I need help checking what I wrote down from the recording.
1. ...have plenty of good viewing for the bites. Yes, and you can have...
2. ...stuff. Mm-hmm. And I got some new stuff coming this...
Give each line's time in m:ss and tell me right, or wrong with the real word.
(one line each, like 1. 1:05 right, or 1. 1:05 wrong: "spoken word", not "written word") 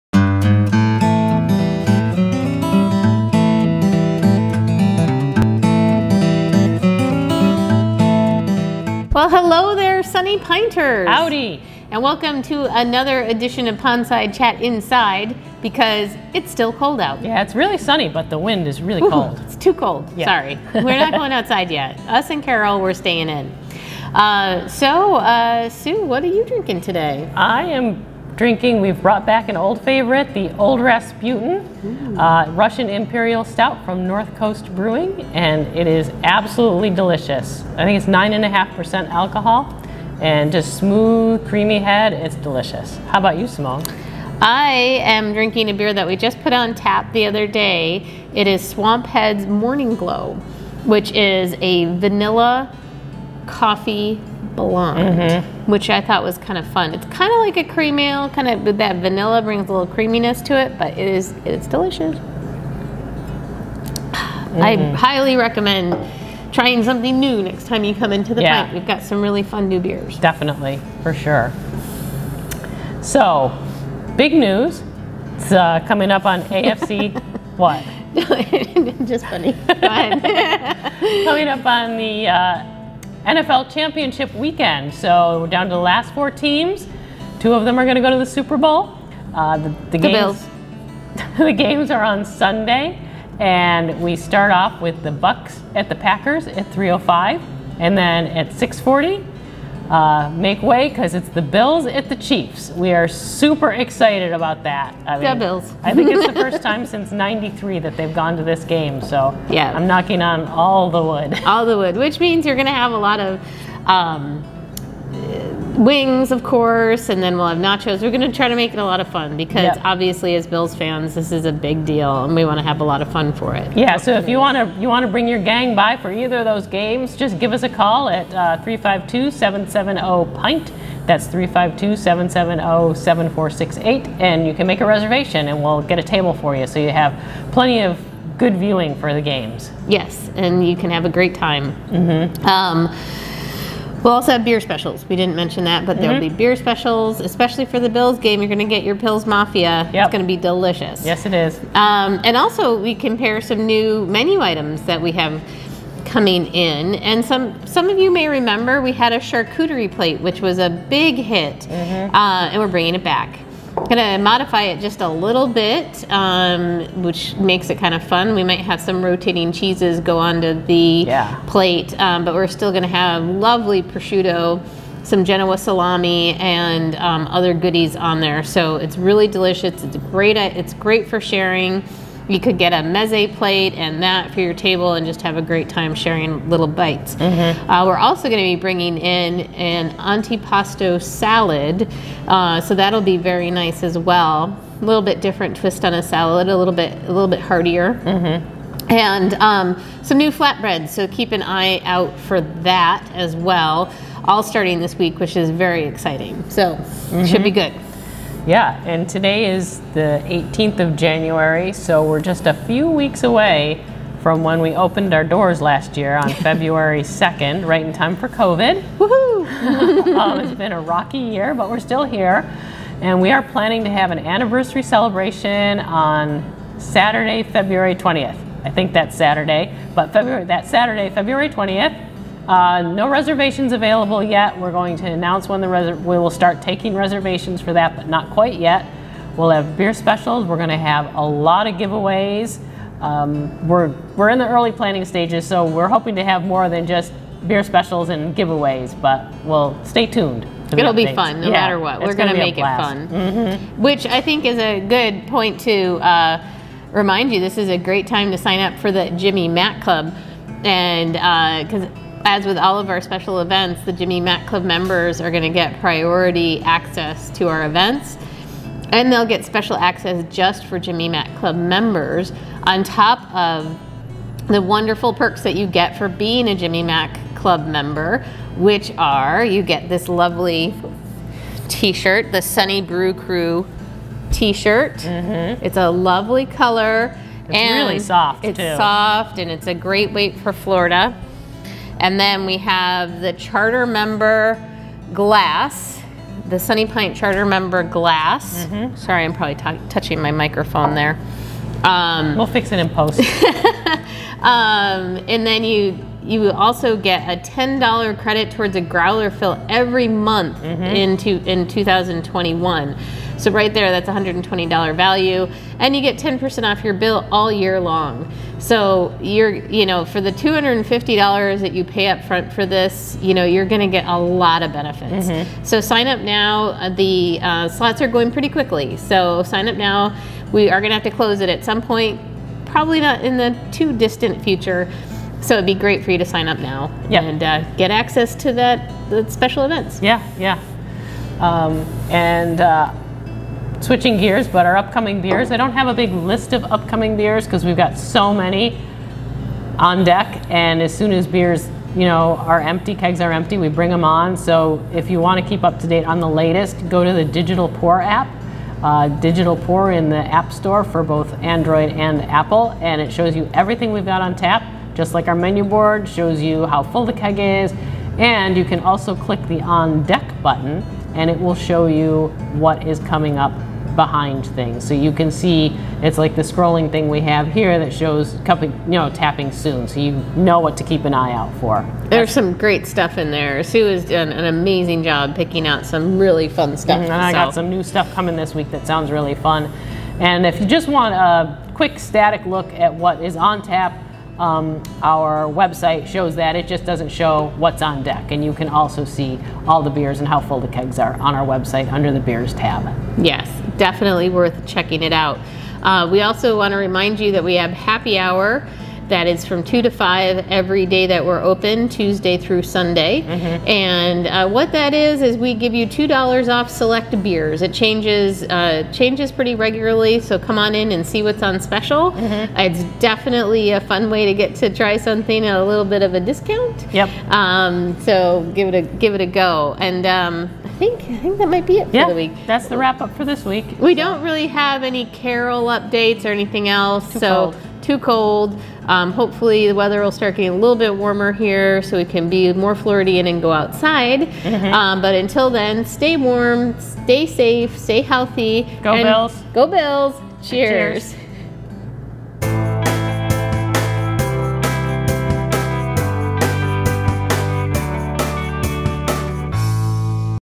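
1. 2:16 wrong: "games", not "bites"
2. 6:26 right.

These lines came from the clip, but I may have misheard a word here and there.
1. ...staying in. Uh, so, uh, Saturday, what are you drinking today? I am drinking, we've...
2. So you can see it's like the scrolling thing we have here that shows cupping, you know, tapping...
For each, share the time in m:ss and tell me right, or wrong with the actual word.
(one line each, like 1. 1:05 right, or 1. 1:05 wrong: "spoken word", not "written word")
1. 0:22 wrong: "Sue", not "Saturday"
2. 6:14 right.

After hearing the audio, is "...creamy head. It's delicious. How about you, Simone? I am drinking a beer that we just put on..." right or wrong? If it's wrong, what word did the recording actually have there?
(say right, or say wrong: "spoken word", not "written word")
right.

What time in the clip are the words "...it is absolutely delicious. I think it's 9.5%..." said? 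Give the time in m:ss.
0:35.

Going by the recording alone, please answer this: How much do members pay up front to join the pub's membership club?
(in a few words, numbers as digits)
$250.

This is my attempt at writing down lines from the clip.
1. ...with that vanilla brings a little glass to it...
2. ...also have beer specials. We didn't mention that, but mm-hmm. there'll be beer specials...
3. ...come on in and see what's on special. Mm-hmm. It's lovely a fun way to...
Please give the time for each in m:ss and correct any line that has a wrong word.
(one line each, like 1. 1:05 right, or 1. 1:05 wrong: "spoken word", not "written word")
1. 0:58 wrong: "creaminess", not "glass"
2. 2:24 right
3. 7:00 wrong: "definitely", not "lovely".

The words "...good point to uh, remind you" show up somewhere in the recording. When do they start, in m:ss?
4:14.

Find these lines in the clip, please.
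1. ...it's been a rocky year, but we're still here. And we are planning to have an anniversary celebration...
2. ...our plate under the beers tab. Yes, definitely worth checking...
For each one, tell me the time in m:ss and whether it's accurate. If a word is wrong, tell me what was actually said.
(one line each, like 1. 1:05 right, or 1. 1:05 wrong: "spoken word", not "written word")
1. 3:40 right
2. 6:41 wrong: "website", not "plate".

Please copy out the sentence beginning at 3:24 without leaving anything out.
All starting this week, which is very exciting.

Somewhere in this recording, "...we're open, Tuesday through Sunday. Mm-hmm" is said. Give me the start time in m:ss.
6:51.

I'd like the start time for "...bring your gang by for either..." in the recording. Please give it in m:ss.
2:05.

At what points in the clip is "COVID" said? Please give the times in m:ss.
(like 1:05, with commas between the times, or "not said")
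3:38.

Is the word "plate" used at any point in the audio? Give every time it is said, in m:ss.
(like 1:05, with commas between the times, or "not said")
2:39, 2:51, 3:03.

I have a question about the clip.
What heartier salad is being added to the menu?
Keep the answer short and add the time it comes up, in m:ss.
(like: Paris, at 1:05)
Antipasto salad, at 3:09.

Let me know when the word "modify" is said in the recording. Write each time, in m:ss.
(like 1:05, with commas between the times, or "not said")
2:44.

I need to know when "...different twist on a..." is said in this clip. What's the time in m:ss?
3:15.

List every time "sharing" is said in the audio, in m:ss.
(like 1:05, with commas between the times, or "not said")
3:01, 3:05.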